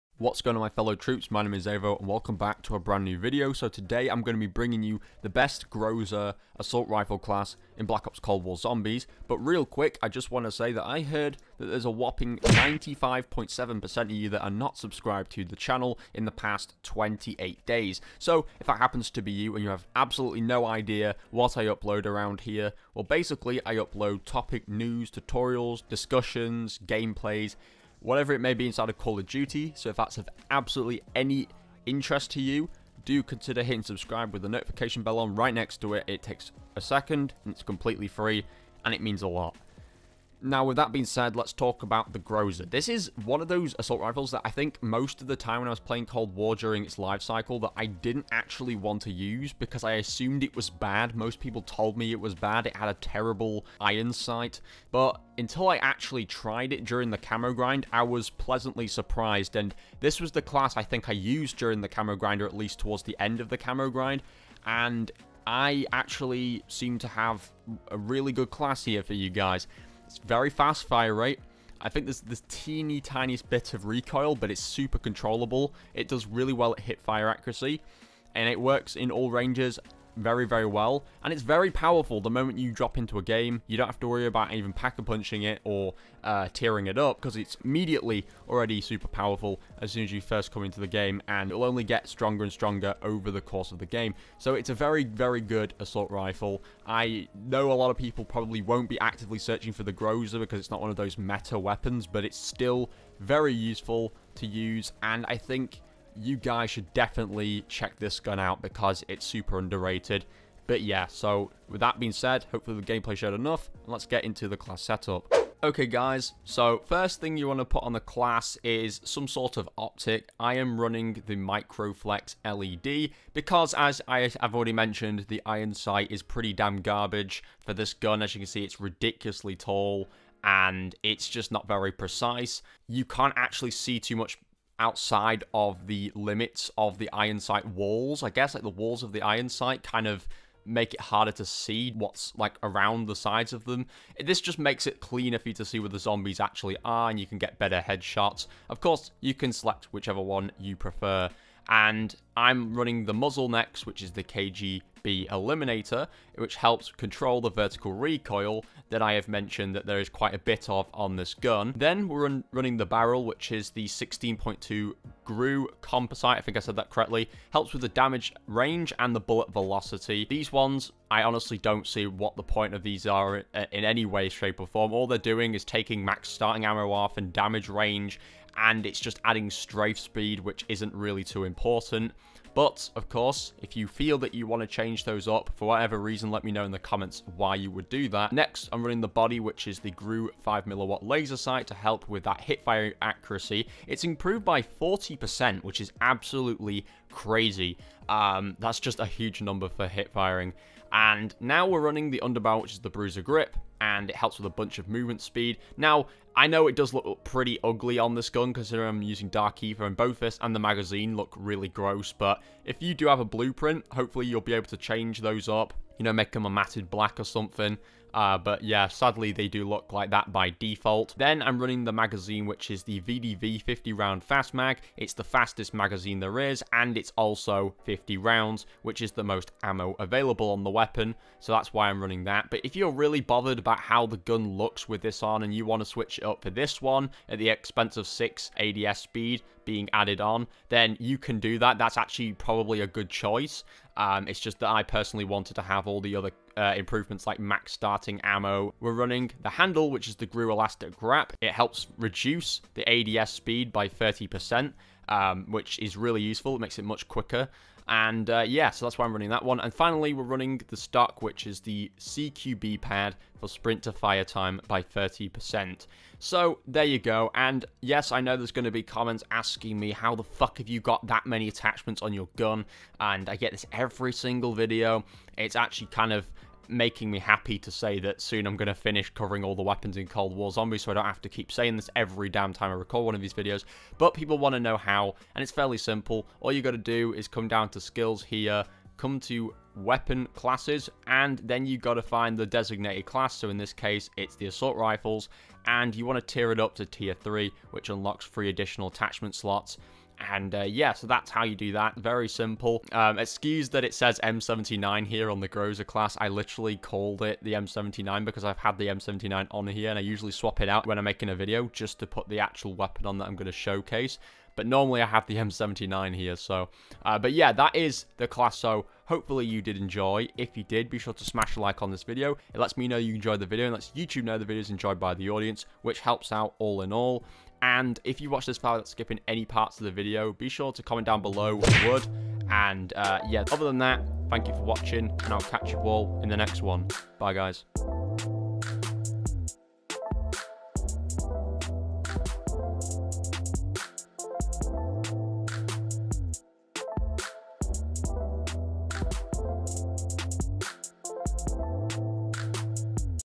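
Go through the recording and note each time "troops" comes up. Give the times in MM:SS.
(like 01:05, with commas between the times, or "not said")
00:00.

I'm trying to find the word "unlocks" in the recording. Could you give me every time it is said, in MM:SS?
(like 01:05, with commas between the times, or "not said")
04:57.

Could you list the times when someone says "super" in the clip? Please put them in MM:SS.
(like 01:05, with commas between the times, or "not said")
01:14, 01:28, 01:49.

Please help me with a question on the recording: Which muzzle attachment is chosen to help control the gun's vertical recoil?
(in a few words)
KGB Eliminator.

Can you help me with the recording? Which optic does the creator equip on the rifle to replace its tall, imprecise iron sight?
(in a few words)
Microflex LED.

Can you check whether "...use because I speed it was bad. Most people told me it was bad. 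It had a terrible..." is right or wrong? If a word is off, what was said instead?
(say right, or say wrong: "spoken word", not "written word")
wrong: "assumed", not "speed".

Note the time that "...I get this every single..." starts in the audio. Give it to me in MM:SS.
04:33.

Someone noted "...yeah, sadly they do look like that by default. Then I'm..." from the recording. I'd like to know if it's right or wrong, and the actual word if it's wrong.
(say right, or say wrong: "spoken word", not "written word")
right.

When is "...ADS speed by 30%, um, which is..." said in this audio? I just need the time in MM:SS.
04:12.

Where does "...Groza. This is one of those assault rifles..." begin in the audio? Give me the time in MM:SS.
00:42.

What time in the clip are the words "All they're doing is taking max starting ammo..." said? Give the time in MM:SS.
02:54.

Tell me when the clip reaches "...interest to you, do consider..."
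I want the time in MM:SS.
00:31.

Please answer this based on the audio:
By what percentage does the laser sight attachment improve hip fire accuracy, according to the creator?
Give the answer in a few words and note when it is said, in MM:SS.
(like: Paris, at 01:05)
40%, at 03:14.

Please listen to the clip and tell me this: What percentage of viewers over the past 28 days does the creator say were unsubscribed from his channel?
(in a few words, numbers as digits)
95.7%.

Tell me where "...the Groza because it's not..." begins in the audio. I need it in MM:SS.
01:39.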